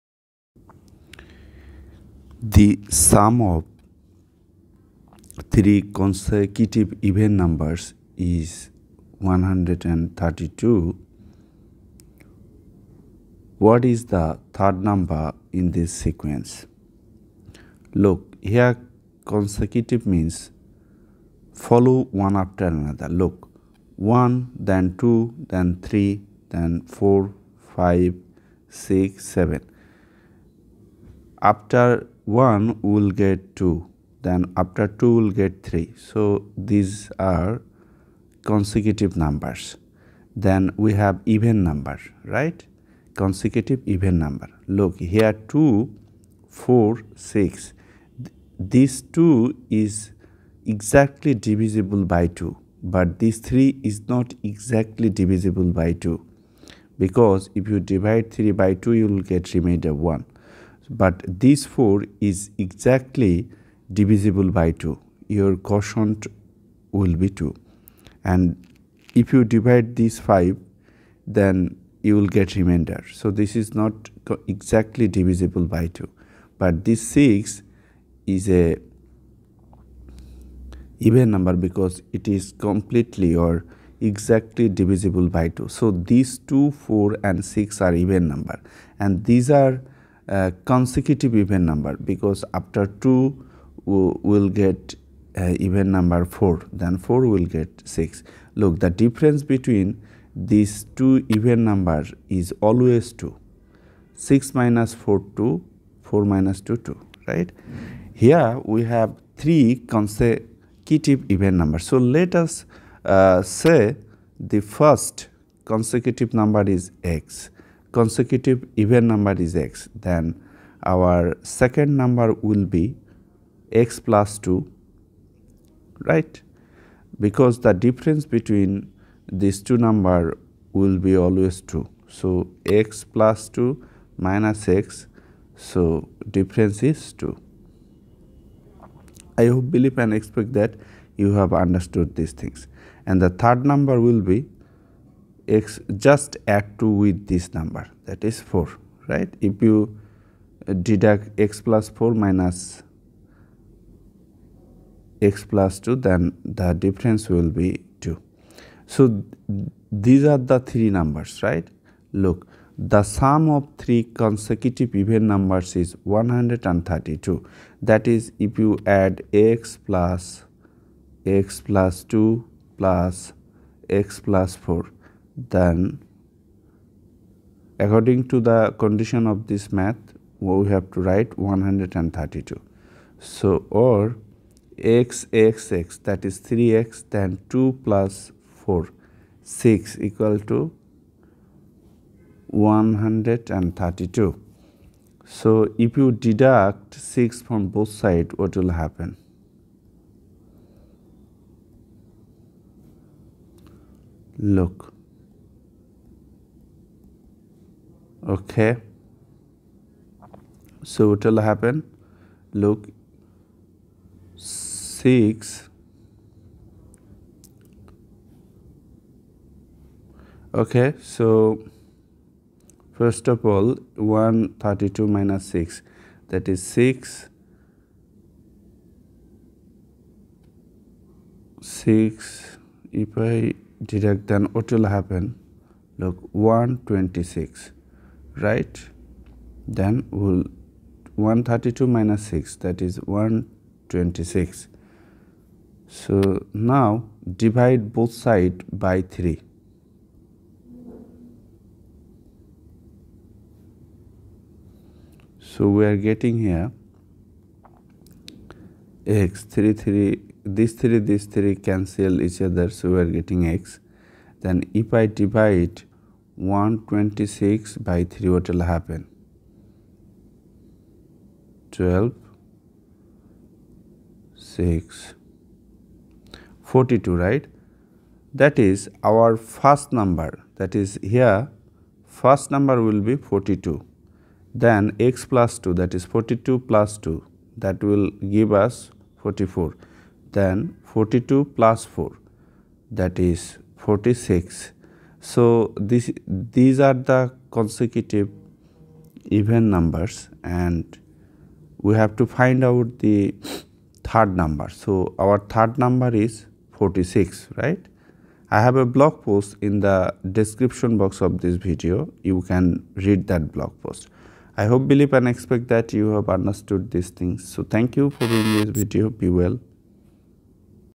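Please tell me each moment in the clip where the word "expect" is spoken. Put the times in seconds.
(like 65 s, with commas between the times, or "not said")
140 s, 315 s.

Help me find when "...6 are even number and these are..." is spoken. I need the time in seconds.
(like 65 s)
87 s.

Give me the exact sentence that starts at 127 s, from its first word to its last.
Because the difference between these two number will be always 2.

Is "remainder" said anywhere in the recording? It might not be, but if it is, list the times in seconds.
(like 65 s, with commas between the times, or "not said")
59 s, 72 s.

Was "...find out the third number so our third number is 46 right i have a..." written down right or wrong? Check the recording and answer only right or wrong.
right.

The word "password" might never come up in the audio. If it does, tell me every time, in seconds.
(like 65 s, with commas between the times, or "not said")
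not said.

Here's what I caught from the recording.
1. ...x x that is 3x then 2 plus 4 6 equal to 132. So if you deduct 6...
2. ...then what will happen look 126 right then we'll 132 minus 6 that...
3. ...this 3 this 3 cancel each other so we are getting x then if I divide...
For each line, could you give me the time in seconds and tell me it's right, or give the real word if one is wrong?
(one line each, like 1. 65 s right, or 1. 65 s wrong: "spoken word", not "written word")
1. 185 s right
2. 234 s right
3. 260 s right.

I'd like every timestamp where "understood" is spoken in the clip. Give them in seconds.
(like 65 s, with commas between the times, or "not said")
141 s, 316 s.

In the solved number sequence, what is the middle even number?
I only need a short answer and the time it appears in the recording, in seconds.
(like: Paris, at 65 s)
44, at 289 s.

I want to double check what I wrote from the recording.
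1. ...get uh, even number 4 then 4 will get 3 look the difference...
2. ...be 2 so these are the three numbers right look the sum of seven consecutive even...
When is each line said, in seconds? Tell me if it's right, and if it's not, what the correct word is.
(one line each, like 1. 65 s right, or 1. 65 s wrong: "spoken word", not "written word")
1. 94 s wrong: "6", not "3"
2. 157 s wrong: "three", not "seven".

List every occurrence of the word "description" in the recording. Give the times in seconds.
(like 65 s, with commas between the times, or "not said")
310 s.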